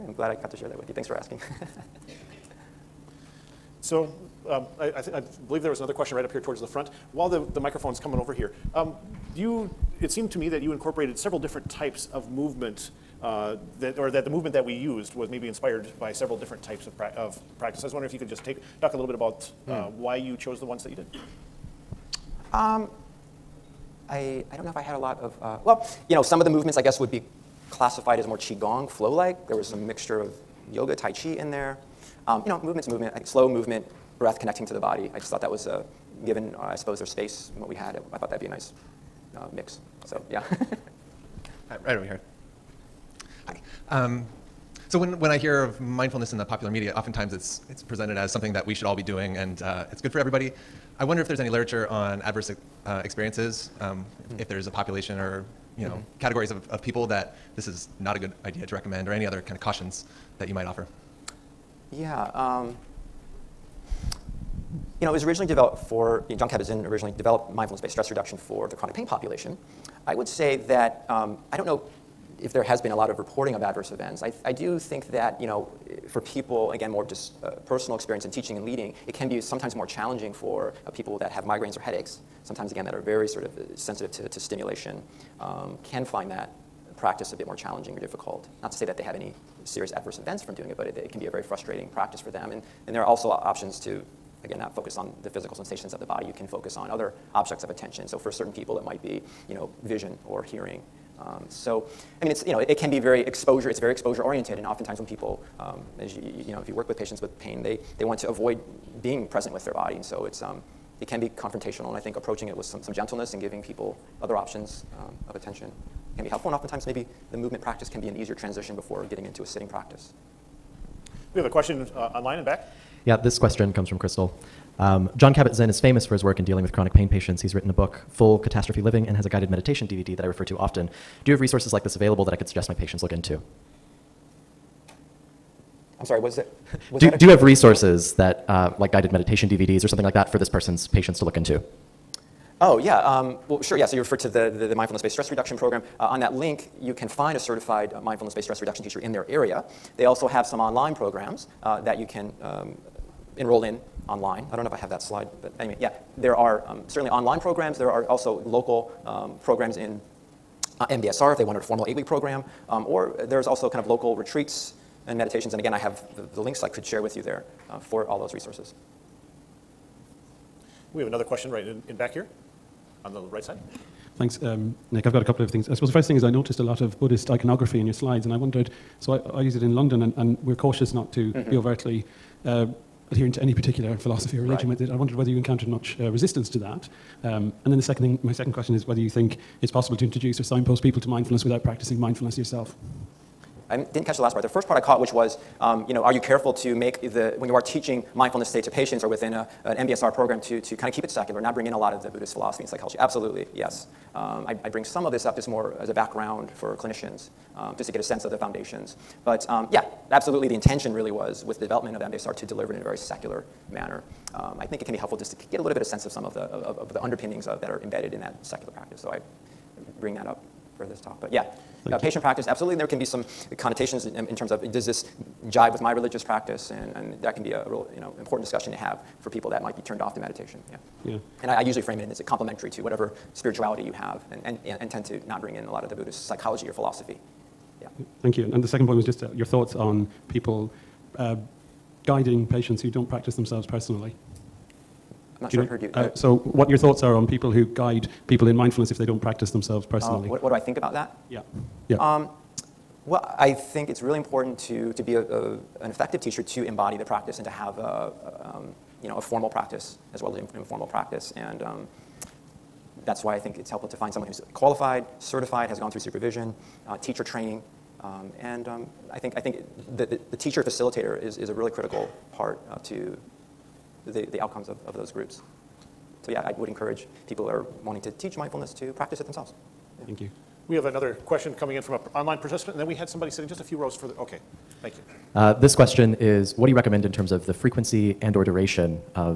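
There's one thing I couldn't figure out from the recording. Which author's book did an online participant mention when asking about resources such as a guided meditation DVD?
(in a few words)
Full Catastrophe Living.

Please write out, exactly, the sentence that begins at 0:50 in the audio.
I wonder if there's any literature on adverse uh, experiences, um, if, hmm.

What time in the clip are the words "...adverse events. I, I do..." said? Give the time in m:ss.
1:13.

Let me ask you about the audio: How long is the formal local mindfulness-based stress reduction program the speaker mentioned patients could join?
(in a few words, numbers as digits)
eight-week.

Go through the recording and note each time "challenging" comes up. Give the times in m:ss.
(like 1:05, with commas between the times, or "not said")
1:19, 1:27.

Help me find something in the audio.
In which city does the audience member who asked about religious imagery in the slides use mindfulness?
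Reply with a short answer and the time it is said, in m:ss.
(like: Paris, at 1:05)
London, at 2:59.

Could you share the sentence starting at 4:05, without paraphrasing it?
I'm not Do sure you know, I heard you.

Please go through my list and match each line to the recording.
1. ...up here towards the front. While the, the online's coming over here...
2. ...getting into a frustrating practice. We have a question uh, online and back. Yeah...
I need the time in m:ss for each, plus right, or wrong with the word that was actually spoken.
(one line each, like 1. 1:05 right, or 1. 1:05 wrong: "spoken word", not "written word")
1. 0:06 wrong: "microphone", not "online"
2. 1:59 wrong: "sitting", not "frustrating".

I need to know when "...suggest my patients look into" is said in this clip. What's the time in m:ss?
2:12.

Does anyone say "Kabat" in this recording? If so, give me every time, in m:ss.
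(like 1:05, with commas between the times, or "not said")
1:06, 2:05.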